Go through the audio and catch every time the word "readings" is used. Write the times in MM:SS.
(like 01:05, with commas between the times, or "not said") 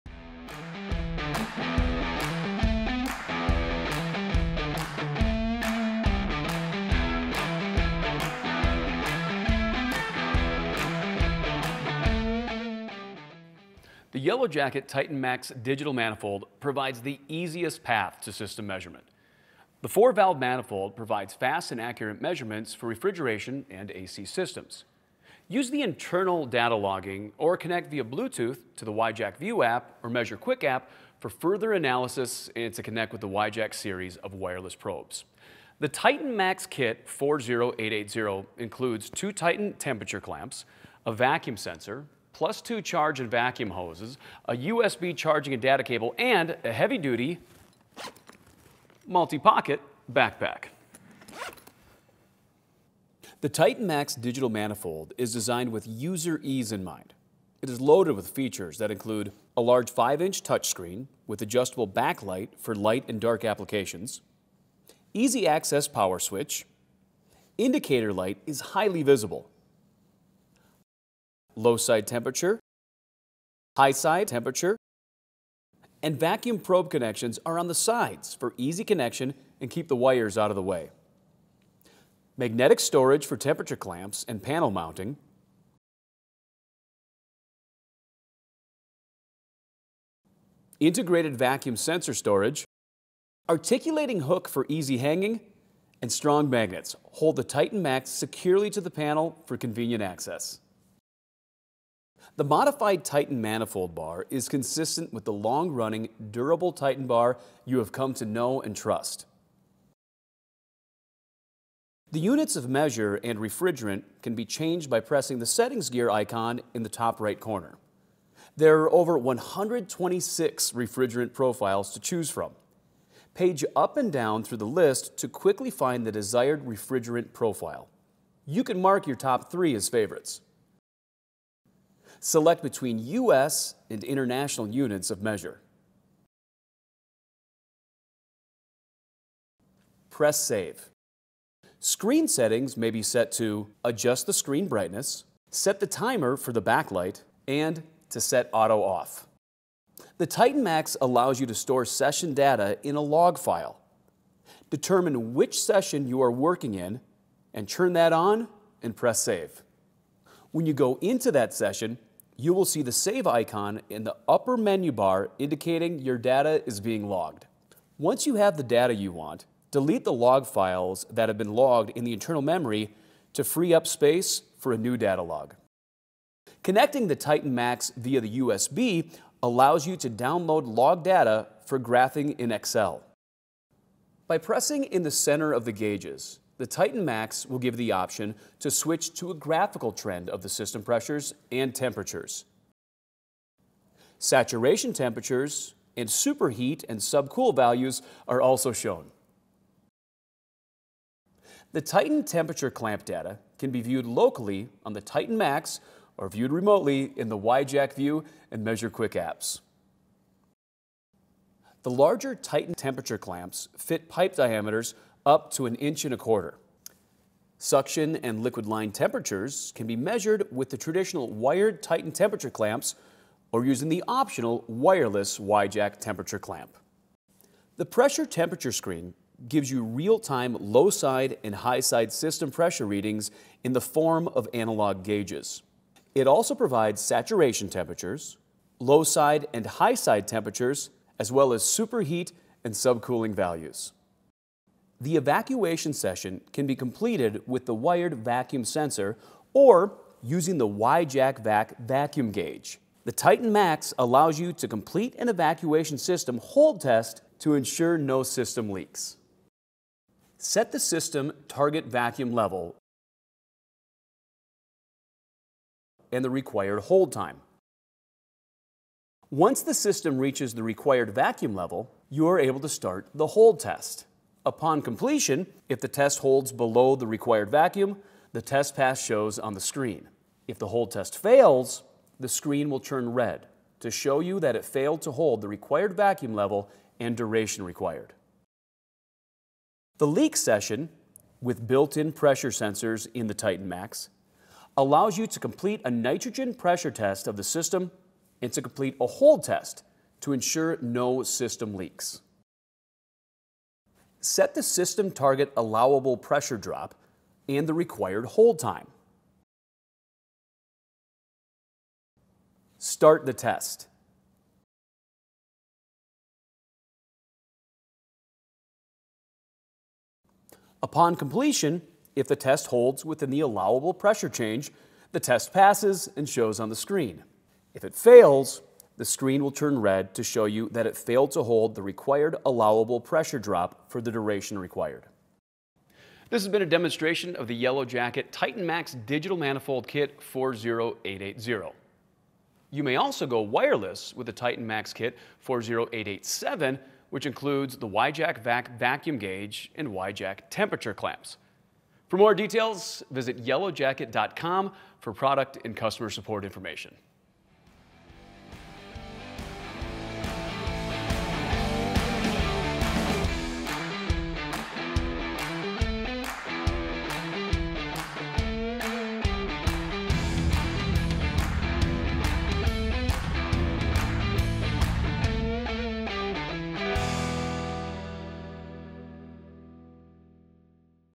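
03:52.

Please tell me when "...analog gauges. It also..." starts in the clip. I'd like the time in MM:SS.
03:54.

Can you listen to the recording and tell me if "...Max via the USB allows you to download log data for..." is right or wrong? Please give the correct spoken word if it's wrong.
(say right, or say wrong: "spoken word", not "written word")
right.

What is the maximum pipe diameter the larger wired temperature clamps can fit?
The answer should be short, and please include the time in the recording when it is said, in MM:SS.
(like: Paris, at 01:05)
an inch and a quarter, at 03:35.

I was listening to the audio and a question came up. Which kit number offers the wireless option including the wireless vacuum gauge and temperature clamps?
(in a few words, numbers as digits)
40887.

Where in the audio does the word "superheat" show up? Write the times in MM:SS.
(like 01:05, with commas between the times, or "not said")
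03:16, 04:01.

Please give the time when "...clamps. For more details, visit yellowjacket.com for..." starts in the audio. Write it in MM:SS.
05:50.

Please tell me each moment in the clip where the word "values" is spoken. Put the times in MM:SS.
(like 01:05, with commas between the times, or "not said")
03:17, 04:03.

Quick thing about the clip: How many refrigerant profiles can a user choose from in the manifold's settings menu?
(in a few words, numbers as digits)
over 126.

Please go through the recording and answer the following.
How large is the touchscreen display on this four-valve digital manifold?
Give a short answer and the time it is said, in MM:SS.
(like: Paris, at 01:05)
5-inch, at 00:59.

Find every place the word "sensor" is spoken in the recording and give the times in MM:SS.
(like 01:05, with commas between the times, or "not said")
00:41, 01:31, 04:08, 04:52.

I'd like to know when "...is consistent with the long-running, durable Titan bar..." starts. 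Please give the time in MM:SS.
01:44.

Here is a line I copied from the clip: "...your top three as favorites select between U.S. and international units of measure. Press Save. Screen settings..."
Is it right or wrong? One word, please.
right.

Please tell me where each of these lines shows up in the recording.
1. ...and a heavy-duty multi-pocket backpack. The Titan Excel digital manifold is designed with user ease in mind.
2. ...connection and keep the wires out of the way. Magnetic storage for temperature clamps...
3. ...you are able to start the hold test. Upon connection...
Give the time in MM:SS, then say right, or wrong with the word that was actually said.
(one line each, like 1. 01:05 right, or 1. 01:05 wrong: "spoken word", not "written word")
1. 00:46 wrong: "Max", not "Excel"
2. 01:18 right
3. 04:32 wrong: "completion", not "connection".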